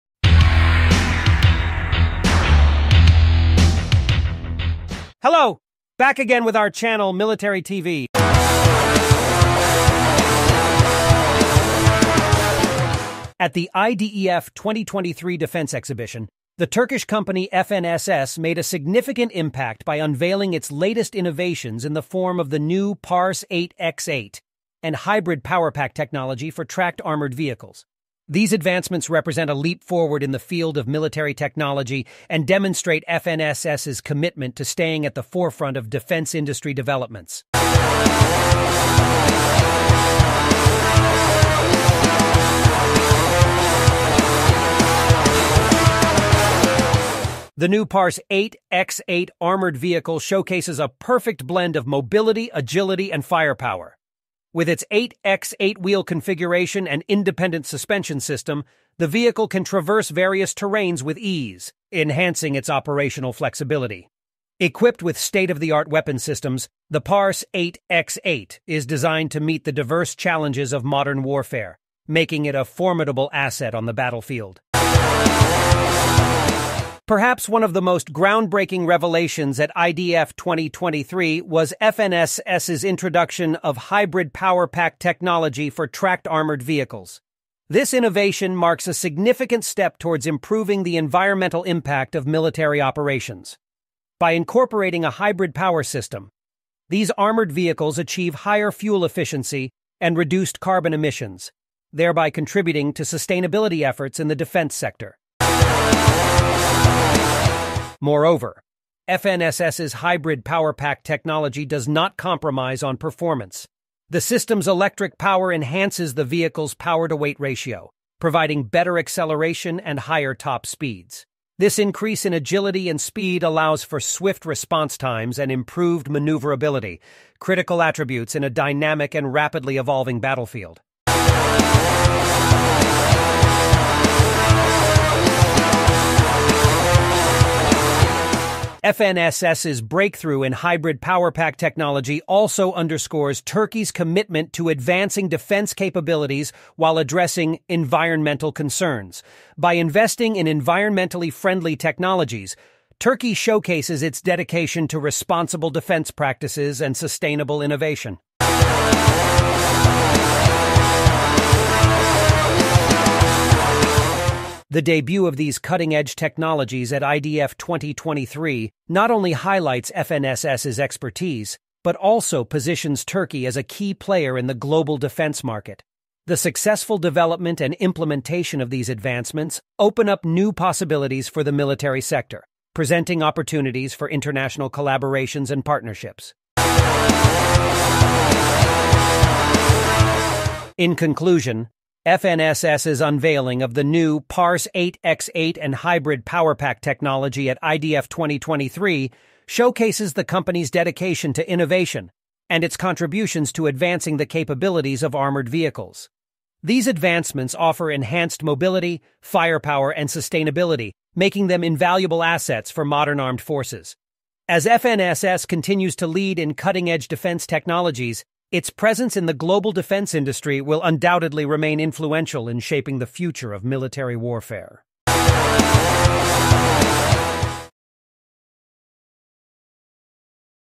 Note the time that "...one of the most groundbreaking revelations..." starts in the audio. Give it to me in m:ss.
1:17.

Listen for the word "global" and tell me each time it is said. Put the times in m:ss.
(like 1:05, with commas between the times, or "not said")
2:54, 3:39.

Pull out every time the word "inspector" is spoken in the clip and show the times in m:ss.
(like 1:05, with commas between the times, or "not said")
not said.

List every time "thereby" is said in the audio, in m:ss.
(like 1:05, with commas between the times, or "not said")
1:41.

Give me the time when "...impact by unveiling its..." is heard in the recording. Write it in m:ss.
0:19.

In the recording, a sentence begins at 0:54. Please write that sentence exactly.
With its 8x8 wheel configuration and independent suspension system, the vehicle can traverse various terrains with ease, enhancing its operational flexibility.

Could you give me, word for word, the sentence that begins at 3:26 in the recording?
These advancements offer enhanced mobility, firepower, and sustainability, making them invaluable assets for modern armed forces.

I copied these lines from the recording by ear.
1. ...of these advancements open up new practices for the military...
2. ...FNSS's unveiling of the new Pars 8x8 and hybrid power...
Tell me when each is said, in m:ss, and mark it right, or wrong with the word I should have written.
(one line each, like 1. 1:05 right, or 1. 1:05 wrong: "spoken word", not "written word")
1. 2:58 wrong: "possibilities", not "practices"
2. 3:12 right.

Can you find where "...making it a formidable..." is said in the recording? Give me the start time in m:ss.
1:12.